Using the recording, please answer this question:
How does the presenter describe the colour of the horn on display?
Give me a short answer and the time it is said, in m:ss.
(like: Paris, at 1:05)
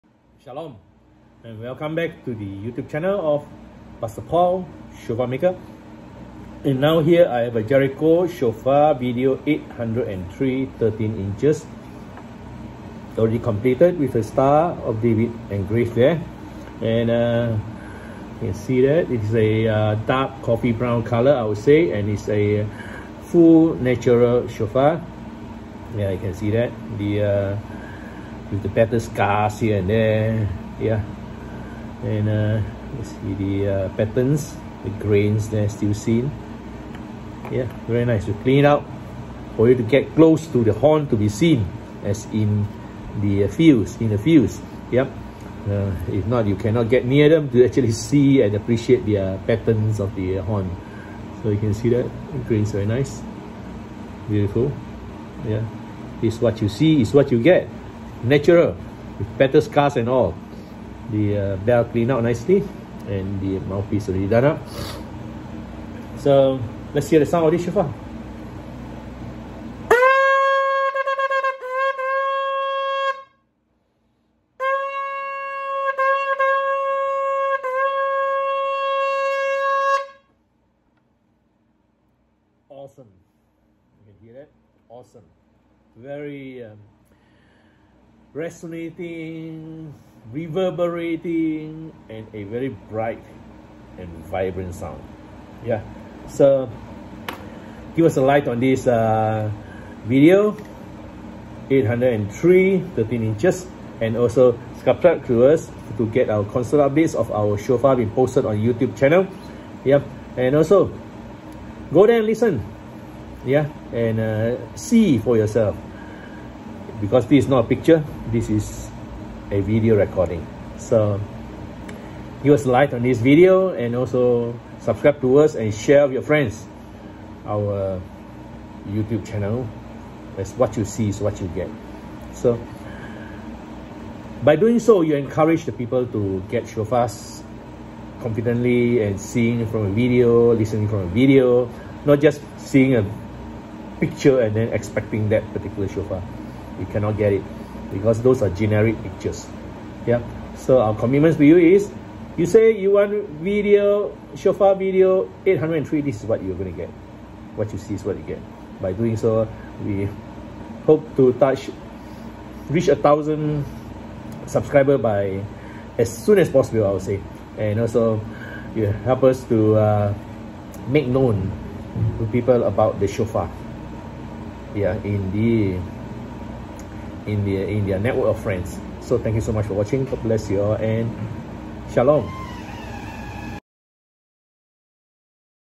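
Dark coffee brown, at 0:20.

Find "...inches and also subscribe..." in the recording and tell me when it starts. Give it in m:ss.
1:43.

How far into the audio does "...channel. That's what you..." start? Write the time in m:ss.
2:09.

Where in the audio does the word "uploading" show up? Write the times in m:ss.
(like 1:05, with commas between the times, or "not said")
not said.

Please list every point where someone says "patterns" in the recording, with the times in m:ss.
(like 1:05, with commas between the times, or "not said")
0:33, 0:49.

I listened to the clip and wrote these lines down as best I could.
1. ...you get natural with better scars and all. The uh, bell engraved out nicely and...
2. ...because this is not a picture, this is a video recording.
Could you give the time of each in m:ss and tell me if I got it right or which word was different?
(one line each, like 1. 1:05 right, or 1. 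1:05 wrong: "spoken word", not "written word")
1. 0:57 wrong: "cleaned", not "engraved"
2. 1:57 right.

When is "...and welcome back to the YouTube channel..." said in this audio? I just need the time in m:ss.
0:01.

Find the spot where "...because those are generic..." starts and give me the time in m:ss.
2:27.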